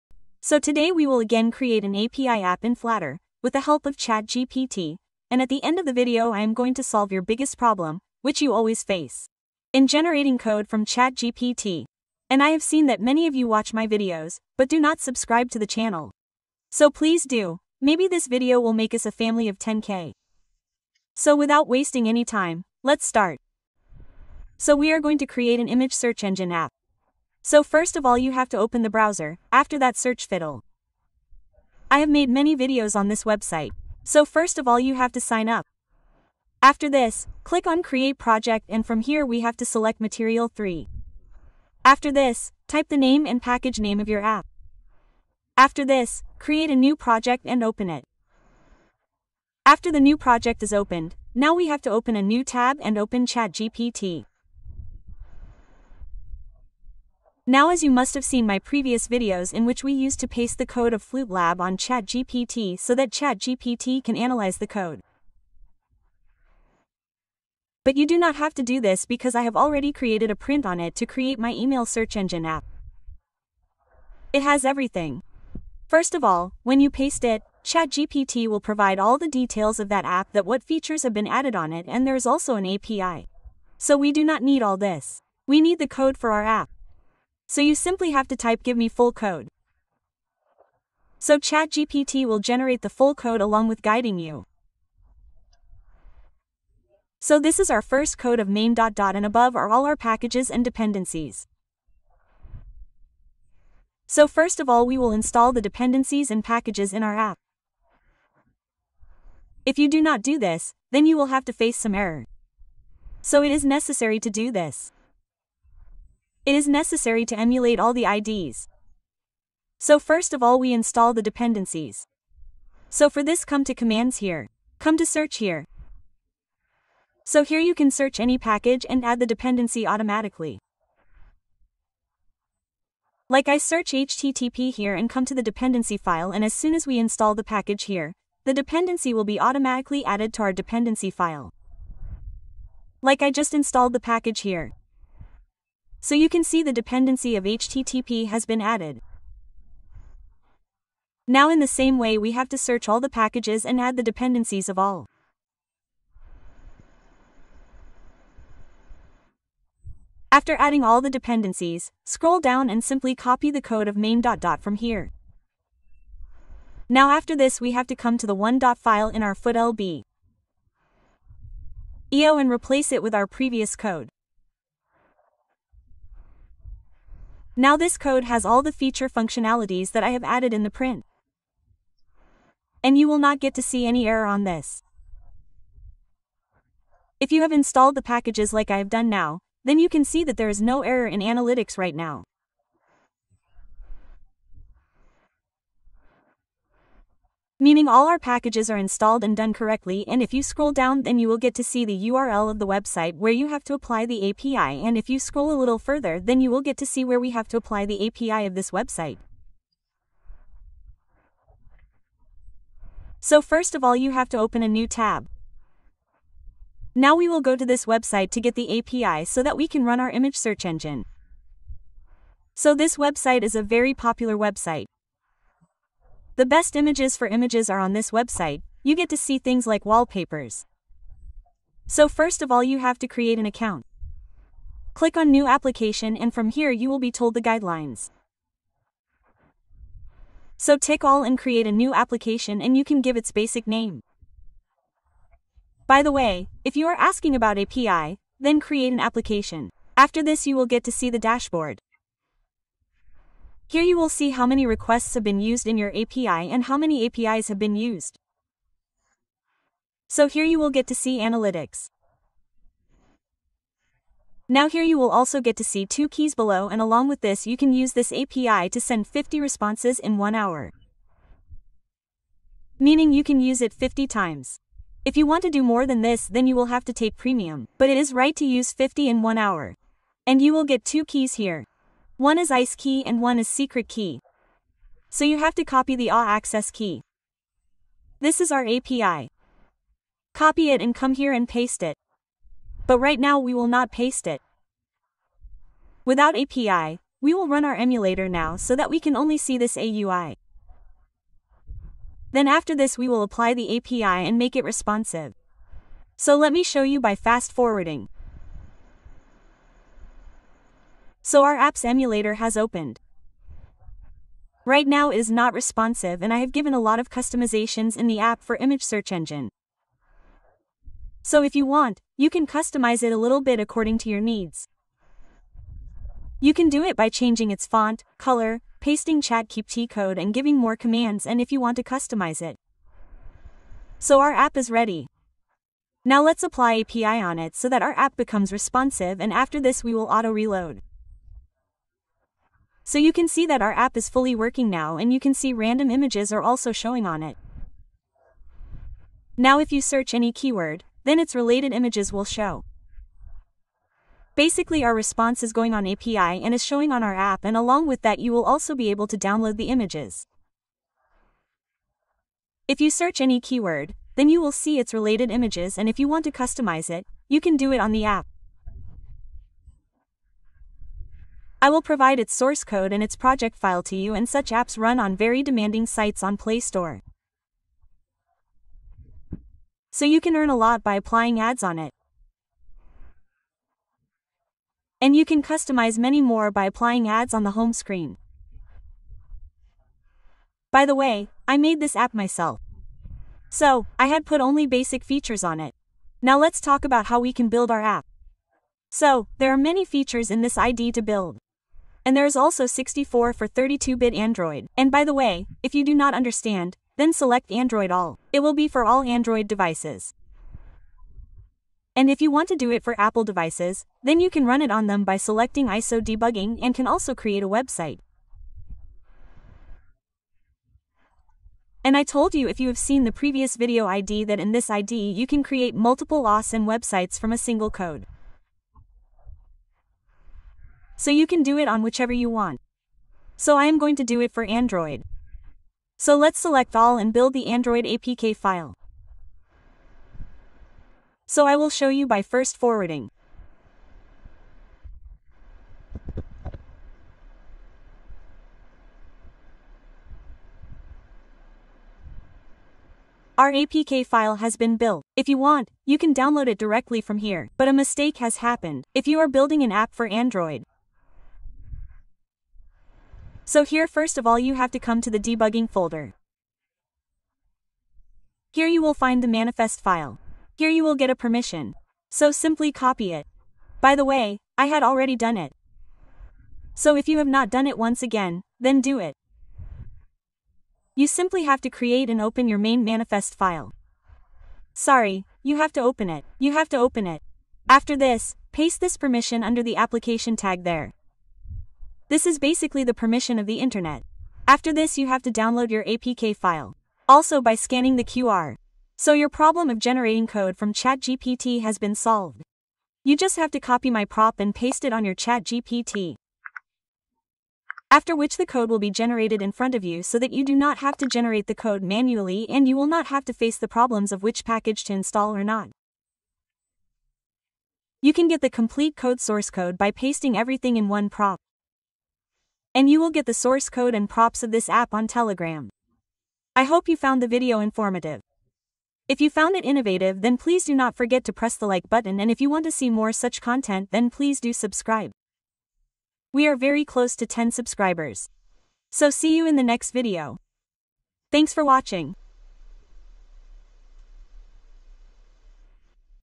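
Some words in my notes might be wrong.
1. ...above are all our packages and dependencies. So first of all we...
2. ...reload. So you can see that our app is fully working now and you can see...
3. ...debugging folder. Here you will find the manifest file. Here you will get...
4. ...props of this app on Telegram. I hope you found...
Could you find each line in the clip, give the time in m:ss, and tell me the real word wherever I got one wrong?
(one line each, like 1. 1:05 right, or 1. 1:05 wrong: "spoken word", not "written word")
1. 1:39 right
2. 5:40 right
3. 7:45 right
4. 8:44 right.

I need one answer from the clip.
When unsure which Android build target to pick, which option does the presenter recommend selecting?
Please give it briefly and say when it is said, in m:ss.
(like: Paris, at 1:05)
Android All, at 6:47.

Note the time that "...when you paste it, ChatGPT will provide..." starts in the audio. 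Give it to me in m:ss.
1:16.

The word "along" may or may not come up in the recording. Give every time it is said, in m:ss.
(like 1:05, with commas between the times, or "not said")
1:33, 4:26, 5:57.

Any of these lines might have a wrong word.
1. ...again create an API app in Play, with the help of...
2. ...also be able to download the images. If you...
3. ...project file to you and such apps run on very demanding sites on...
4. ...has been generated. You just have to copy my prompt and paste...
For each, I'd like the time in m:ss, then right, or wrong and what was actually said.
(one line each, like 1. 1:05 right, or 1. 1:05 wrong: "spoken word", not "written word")
1. 0:01 wrong: "Flutter", not "Play"
2. 5:58 right
3. 6:13 right
4. 8:21 wrong: "solved", not "generated".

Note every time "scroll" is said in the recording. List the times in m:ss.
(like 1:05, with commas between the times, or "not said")
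2:42, 3:20, 3:25.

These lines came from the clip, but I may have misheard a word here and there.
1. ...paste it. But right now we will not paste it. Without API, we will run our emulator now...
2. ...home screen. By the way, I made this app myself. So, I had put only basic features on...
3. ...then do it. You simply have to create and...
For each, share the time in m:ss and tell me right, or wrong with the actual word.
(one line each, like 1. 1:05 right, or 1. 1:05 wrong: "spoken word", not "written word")
1. 4:51 right
2. 6:27 right
3. 7:58 right.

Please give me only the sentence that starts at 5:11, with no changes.
So our apps emulator has opened.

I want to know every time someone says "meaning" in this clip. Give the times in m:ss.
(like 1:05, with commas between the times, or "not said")
3:17, 4:32.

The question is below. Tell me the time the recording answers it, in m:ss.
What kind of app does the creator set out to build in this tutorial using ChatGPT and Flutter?
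0:25.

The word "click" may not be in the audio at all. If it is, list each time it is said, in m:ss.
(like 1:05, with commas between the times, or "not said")
0:37, 3:54.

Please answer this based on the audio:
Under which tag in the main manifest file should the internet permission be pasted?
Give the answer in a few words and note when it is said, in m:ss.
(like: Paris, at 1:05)
application tag, at 8:09.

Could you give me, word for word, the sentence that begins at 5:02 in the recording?
Then after this we will apply the API and make it responsive.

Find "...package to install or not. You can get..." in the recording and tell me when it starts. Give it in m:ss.
8:34.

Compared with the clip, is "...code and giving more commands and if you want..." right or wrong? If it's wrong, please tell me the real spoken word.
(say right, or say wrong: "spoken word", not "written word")
right.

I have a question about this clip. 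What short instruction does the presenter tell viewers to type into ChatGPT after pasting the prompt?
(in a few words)
give me full code.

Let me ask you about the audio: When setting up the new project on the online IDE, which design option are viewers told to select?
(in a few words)
Material 3.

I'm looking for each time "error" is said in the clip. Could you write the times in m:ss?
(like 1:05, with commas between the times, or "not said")
1:51, 3:04, 3:10.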